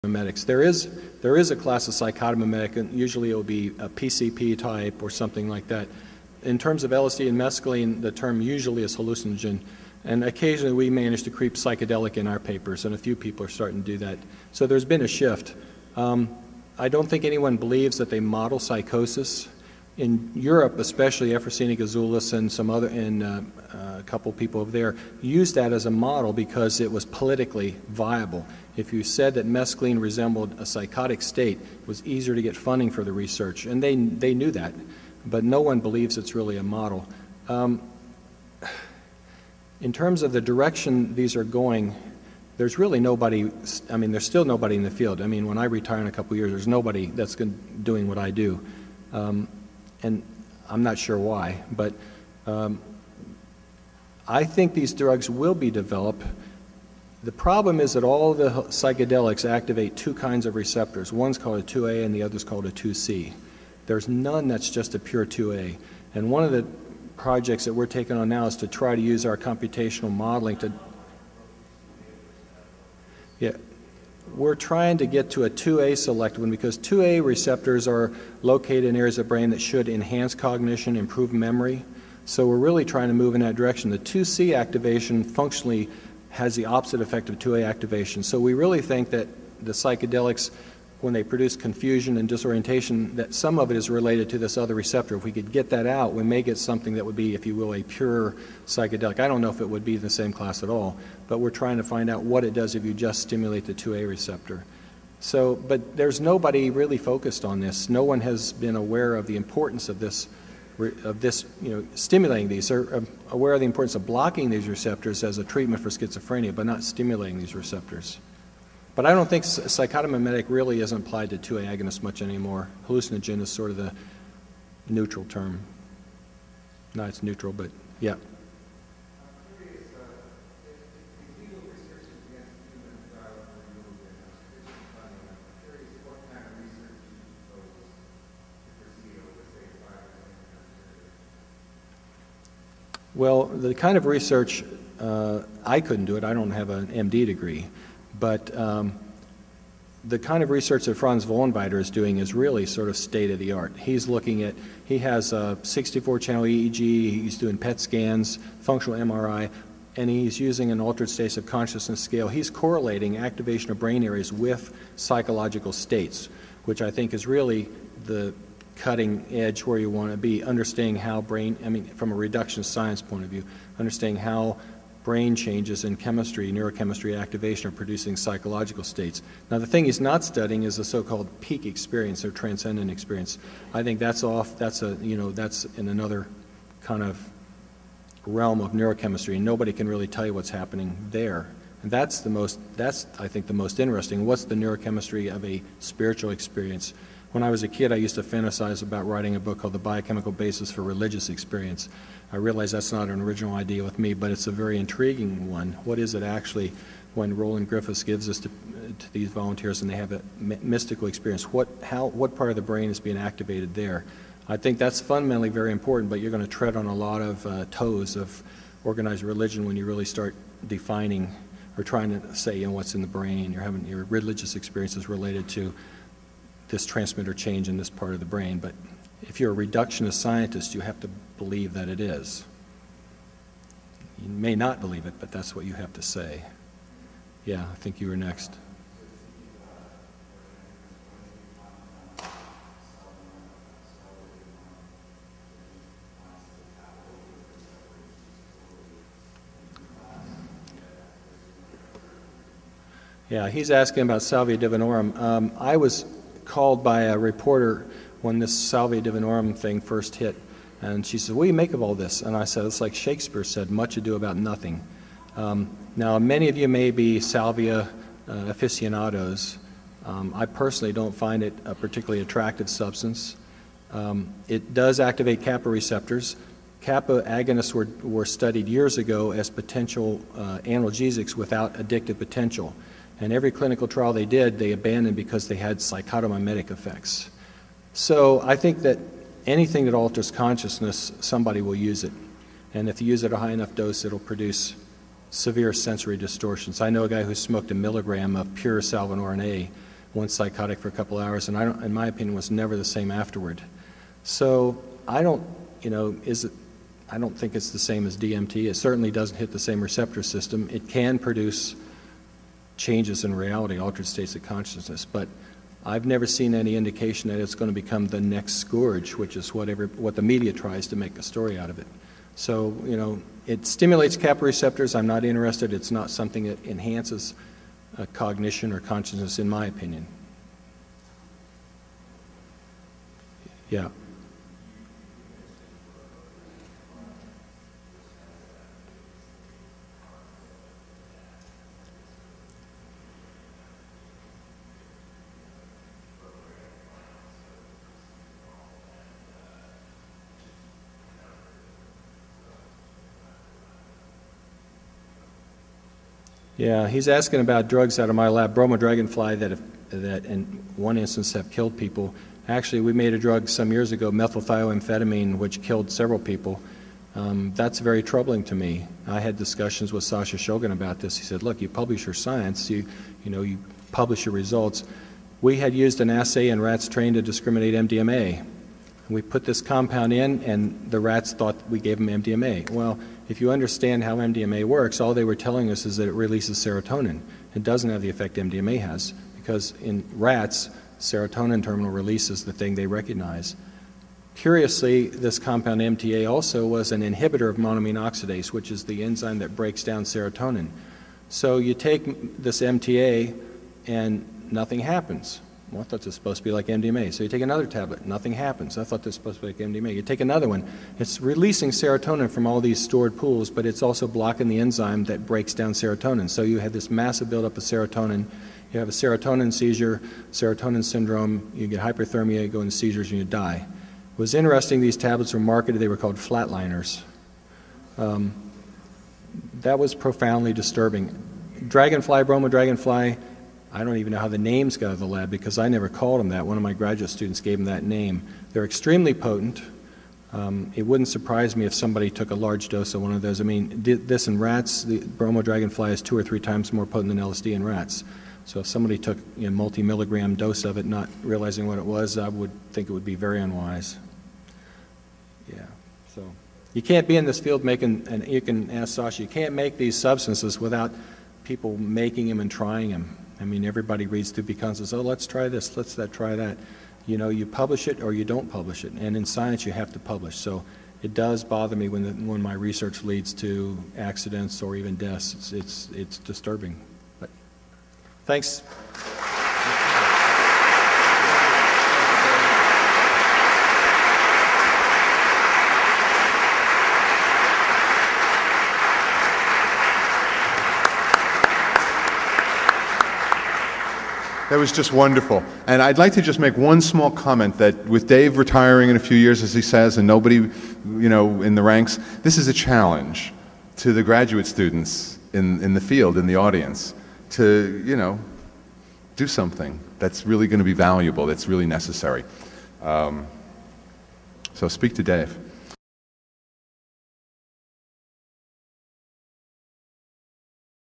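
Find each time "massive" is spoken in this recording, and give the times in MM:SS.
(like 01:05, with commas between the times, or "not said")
06:56.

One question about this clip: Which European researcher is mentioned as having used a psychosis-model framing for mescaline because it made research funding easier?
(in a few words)
Euphrosyne Gouzoulis.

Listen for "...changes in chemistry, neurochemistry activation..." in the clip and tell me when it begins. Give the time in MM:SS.
02:55.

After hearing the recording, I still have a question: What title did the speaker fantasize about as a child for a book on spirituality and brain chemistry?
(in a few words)
The Biochemical Basis for Religious Experience.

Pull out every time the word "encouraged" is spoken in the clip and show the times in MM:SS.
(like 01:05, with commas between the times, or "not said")
not said.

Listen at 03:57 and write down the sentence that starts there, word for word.
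Yeah, I think you were next.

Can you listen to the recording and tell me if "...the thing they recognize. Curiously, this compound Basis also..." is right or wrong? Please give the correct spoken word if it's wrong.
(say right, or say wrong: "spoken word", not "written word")
wrong: "MTA", not "Basis".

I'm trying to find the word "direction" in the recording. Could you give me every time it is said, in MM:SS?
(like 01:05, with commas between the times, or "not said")
00:40, 01:23.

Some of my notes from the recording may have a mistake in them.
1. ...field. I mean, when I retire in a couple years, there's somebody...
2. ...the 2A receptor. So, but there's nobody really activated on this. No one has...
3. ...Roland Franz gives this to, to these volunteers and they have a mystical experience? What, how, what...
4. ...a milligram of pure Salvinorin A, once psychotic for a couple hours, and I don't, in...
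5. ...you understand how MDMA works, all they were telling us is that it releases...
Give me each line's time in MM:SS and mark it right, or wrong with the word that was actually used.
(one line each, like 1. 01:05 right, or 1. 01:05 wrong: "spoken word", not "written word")
1. 00:44 wrong: "nobody", not "somebody"
2. 01:43 wrong: "focused", not "activated"
3. 03:27 wrong: "Griffiths", not "Franz"
4. 04:57 right
5. 06:23 right.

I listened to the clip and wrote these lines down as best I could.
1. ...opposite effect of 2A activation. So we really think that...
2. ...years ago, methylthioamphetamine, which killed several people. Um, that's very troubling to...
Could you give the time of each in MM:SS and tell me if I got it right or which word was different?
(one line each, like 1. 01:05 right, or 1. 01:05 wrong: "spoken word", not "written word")
1. 01:26 right
2. 06:03 right.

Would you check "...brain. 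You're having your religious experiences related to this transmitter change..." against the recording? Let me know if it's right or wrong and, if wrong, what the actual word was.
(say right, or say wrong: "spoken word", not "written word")
right.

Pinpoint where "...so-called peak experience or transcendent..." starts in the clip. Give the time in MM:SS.
03:00.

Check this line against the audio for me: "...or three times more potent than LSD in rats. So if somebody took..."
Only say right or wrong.
right.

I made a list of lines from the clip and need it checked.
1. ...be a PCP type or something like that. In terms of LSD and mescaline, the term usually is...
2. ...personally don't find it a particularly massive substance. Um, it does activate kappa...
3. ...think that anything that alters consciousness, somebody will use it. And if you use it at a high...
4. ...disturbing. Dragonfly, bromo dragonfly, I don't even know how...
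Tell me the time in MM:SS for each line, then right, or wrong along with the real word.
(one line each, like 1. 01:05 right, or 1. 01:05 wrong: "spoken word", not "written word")
1. 00:03 right
2. 04:30 wrong: "attractive", not "massive"
3. 04:48 right
4. 07:10 right.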